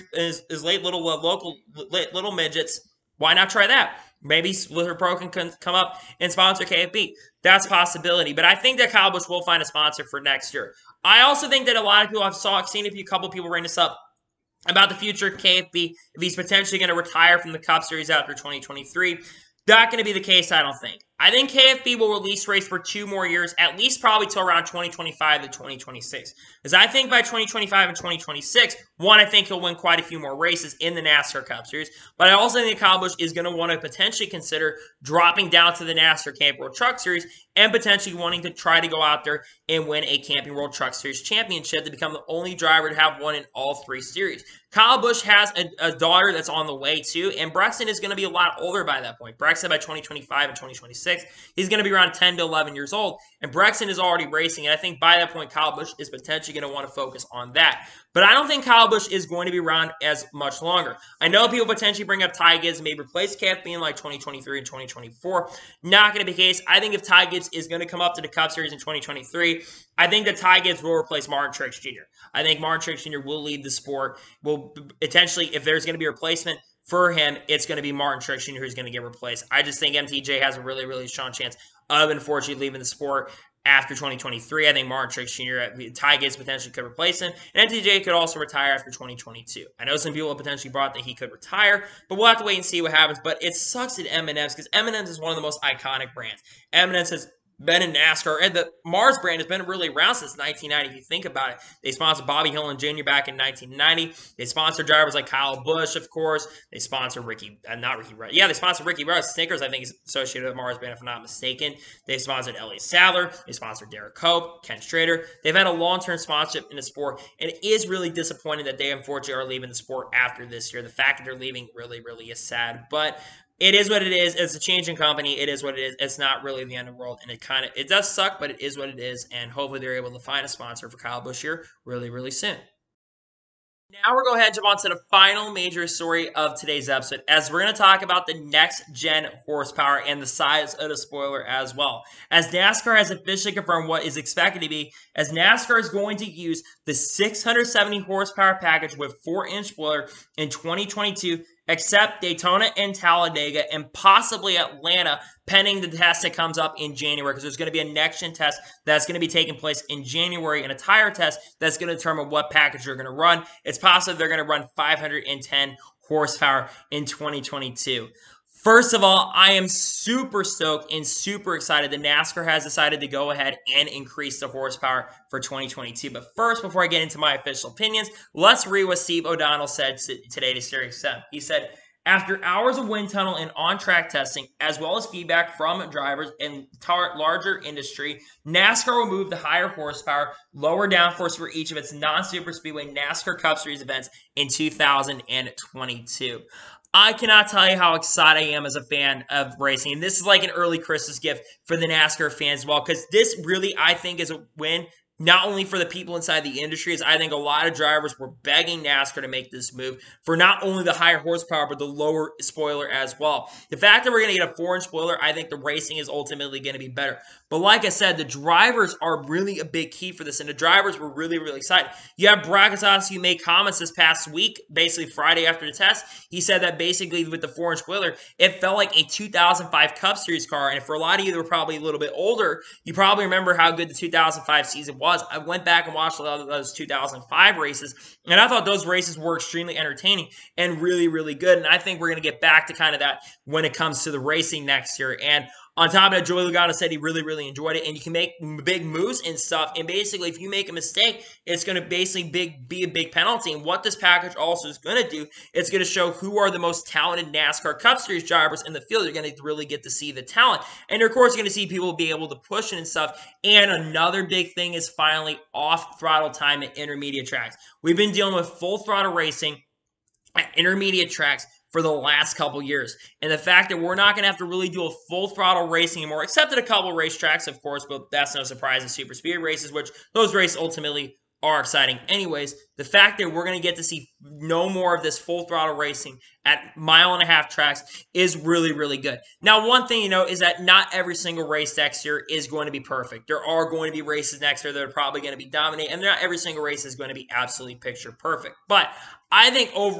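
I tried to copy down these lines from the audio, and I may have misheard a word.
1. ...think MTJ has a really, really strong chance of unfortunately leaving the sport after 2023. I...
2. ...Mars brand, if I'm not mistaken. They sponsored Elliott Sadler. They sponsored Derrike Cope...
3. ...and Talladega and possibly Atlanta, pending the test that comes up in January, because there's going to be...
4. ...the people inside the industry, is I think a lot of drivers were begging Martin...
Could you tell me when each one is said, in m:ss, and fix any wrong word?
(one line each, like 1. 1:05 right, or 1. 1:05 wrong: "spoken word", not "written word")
1. 1:19 right
2. 1:50 right
3. 2:32 right
4. 3:25 wrong: "NASCAR", not "Martin".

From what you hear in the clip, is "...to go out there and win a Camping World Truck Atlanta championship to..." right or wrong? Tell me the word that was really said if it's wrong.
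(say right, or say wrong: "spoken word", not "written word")
wrong: "Series", not "Atlanta".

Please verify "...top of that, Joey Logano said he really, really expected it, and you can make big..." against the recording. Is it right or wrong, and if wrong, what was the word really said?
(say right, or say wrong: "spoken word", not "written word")
wrong: "enjoyed", not "expected".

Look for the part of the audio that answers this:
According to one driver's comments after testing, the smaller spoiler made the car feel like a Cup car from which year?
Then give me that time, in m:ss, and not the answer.
3:49.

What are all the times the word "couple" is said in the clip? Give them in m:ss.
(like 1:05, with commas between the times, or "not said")
0:13, 4:32, 4:36.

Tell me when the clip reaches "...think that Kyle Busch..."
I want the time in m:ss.
0:08.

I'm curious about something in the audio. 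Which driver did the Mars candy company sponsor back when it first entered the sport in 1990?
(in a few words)
Bobby Hillin Jr.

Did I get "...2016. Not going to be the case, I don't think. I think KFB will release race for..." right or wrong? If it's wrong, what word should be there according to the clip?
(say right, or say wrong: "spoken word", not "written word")
wrong: "2023", not "2016".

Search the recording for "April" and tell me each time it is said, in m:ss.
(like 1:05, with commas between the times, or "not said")
not said.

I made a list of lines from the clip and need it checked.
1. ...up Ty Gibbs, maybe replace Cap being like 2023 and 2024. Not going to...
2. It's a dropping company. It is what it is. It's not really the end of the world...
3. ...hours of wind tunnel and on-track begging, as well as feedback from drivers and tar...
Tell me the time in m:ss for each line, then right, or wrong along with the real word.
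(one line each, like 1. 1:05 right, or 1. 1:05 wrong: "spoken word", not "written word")
1. 1:02 right
2. 2:04 wrong: "changing", not "dropping"
3. 3:02 wrong: "testing", not "begging".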